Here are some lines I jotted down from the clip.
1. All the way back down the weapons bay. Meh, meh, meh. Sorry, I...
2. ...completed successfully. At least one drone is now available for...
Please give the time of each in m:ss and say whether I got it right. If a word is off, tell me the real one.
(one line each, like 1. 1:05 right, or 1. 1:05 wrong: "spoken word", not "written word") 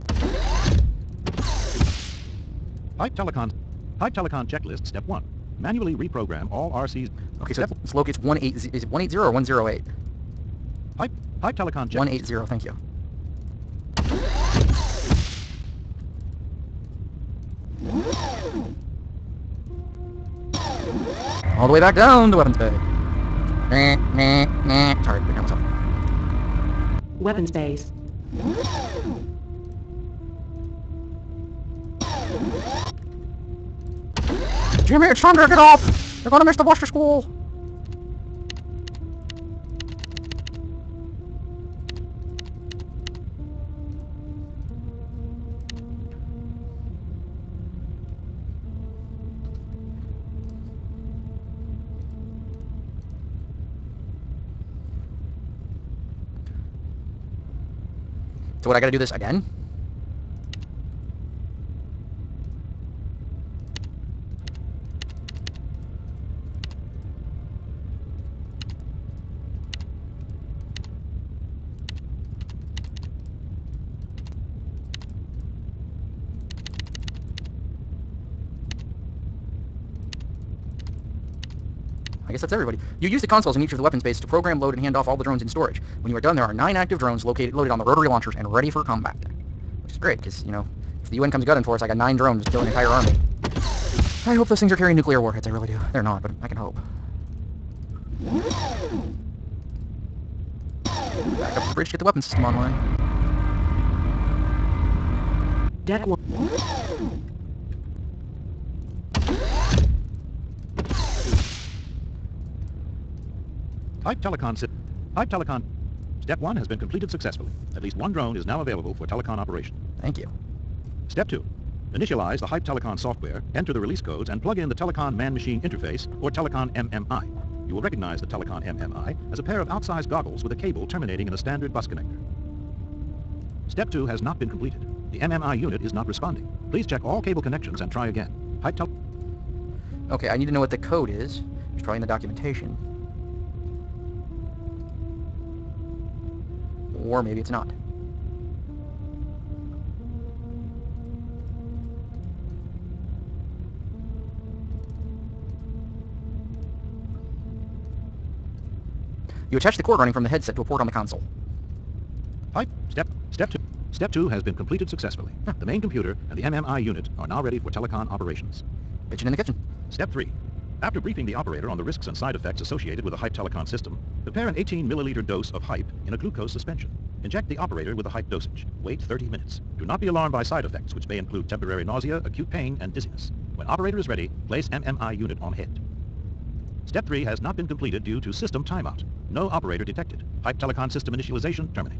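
1. 0:21 right
2. 1:56 right.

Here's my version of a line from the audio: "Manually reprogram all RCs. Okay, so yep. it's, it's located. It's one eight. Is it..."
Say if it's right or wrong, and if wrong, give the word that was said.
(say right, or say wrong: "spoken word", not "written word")
right.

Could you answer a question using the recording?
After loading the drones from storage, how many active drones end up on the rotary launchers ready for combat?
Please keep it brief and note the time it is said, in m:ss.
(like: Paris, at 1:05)
9, at 1:26.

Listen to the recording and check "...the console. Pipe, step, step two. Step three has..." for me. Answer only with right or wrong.
wrong.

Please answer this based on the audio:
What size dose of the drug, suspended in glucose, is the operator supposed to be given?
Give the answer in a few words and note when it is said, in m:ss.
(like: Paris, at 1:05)
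18 milliliters, at 2:54.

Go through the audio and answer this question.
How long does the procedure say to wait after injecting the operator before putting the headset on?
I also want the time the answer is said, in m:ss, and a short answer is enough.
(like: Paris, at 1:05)
30 minutes, at 2:59.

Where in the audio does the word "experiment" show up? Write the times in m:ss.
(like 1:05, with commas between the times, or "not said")
not said.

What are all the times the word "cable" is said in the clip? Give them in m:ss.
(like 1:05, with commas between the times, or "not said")
2:10, 2:17.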